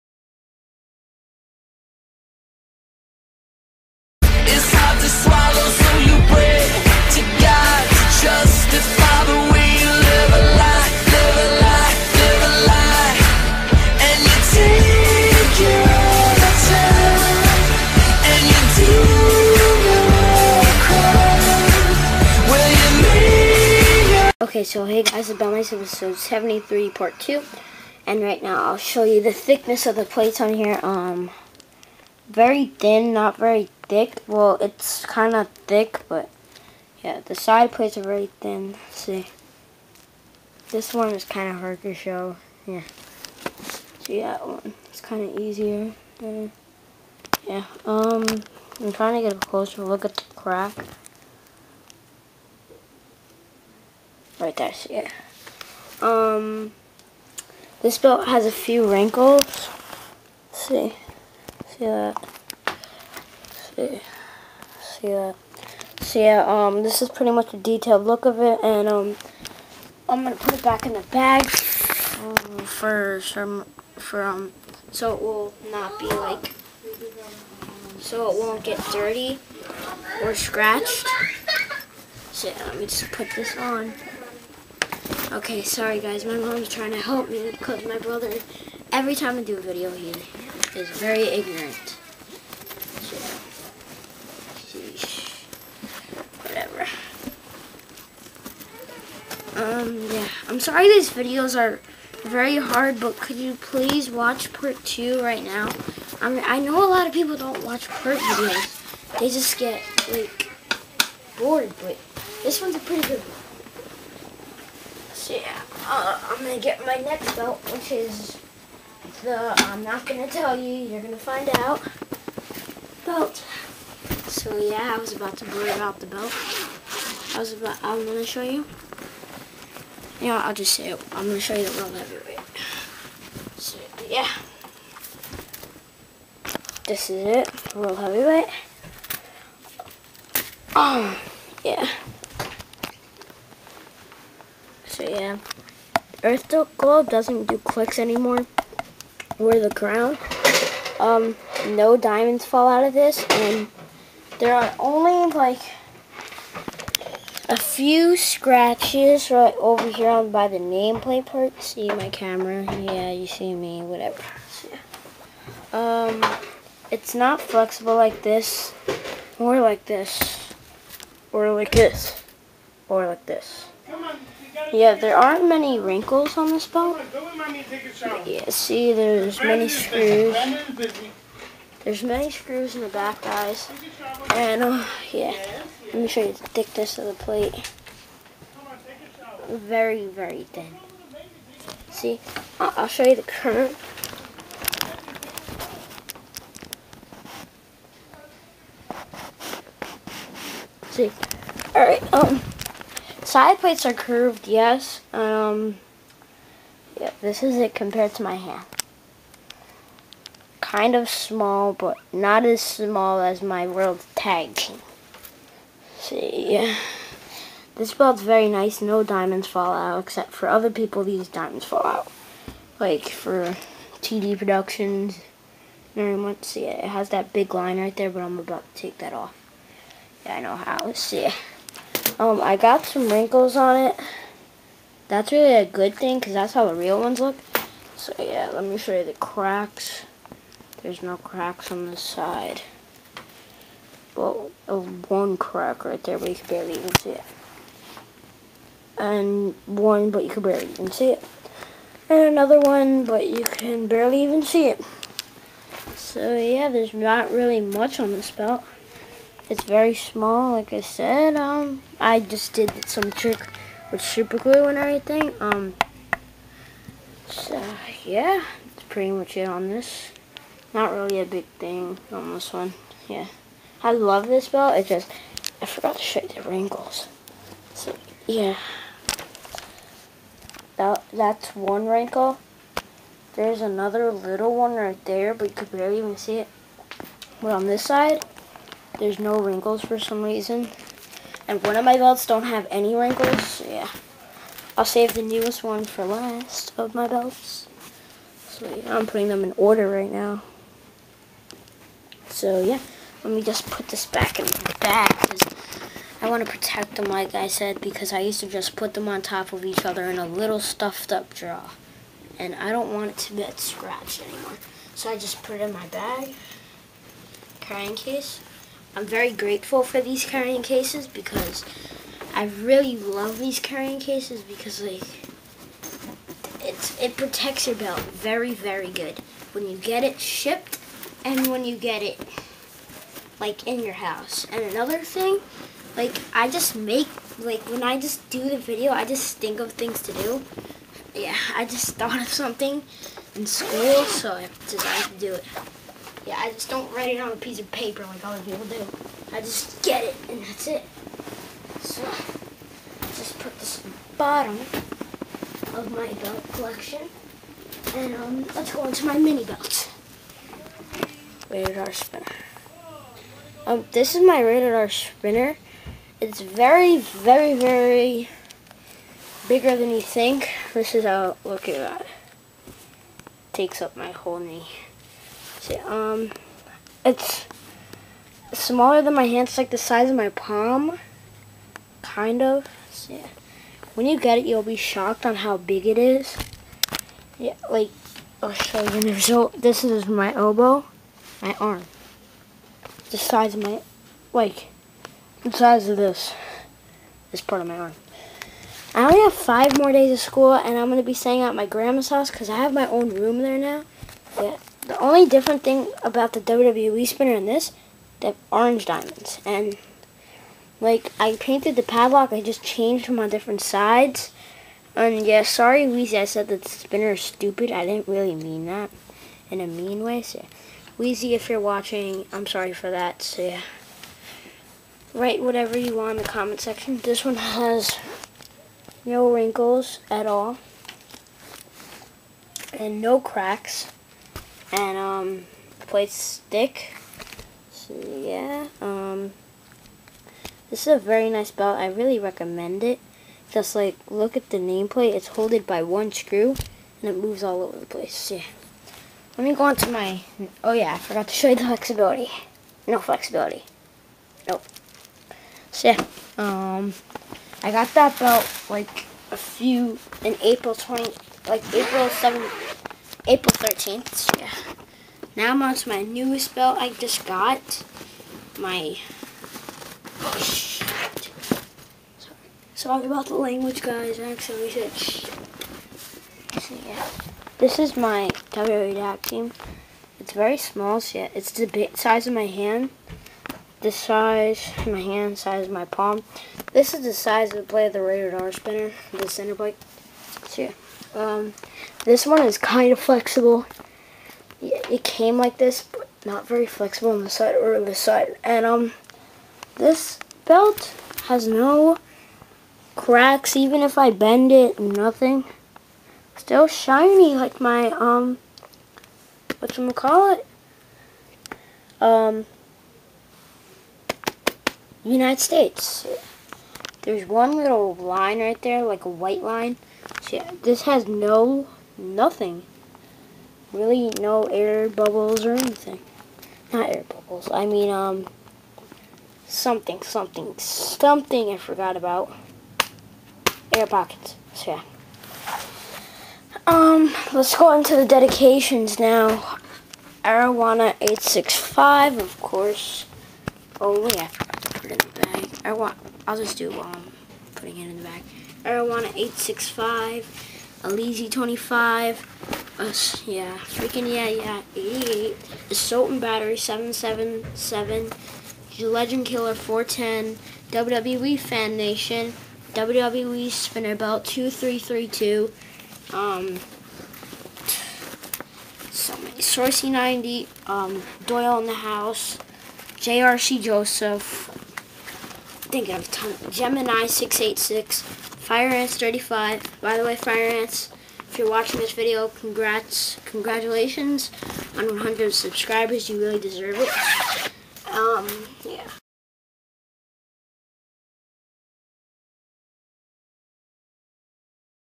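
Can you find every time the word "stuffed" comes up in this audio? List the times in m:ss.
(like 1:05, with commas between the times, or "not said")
5:10.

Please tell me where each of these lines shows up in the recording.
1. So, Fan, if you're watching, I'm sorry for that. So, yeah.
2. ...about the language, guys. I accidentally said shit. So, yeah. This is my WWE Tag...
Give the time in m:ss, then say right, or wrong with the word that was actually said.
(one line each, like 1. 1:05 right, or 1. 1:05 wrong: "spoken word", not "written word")
1. 7:00 wrong: "Weezy", not "Fan"
2. 7:53 right.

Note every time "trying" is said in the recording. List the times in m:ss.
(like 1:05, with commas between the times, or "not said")
0:48, 1:26.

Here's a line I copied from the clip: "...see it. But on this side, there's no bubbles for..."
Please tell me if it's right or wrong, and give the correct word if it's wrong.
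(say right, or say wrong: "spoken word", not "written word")
wrong: "wrinkles", not "bubbles".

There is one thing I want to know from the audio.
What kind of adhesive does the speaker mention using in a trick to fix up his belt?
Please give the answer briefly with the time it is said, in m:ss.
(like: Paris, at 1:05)
super glue, at 4:23.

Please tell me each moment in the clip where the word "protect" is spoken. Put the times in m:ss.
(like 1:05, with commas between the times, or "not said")
5:06, 5:27.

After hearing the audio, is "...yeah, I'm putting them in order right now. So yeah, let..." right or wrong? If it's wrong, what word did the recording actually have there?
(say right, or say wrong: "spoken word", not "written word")
right.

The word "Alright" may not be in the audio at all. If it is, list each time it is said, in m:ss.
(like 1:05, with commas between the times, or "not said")
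3:21.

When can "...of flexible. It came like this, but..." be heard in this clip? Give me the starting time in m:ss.
8:12.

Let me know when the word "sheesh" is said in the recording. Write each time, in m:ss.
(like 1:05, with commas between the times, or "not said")
1:34.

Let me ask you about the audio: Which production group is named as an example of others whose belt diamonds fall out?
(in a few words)
TD Productions.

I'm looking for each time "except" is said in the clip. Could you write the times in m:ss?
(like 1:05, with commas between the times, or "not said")
3:40.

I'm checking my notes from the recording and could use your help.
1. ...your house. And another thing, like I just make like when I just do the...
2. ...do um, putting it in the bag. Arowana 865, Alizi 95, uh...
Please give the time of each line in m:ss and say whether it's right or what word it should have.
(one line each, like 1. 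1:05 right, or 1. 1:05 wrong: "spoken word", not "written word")
1. 5:33 right
2. 9:06 wrong: "25", not "95".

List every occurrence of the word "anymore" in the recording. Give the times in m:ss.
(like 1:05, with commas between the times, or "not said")
2:27, 5:14.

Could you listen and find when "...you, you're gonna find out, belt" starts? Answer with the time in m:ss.
2:00.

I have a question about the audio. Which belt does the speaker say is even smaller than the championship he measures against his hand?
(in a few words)
World Tag Team.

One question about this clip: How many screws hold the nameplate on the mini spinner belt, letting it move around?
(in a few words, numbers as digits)
1.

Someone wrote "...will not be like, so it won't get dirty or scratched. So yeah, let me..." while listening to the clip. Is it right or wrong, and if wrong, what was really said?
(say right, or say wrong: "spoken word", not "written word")
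right.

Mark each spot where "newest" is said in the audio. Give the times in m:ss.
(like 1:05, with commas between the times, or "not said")
4:55, 7:46.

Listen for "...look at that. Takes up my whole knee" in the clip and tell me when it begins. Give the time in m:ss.
6:11.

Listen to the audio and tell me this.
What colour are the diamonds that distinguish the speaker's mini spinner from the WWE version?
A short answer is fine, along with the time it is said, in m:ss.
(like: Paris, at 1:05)
orange, at 6:48.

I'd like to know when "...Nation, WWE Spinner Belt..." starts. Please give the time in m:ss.
9:21.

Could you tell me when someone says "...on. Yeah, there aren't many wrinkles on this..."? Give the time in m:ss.
2:54.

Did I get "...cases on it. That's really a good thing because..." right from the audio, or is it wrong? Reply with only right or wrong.
wrong.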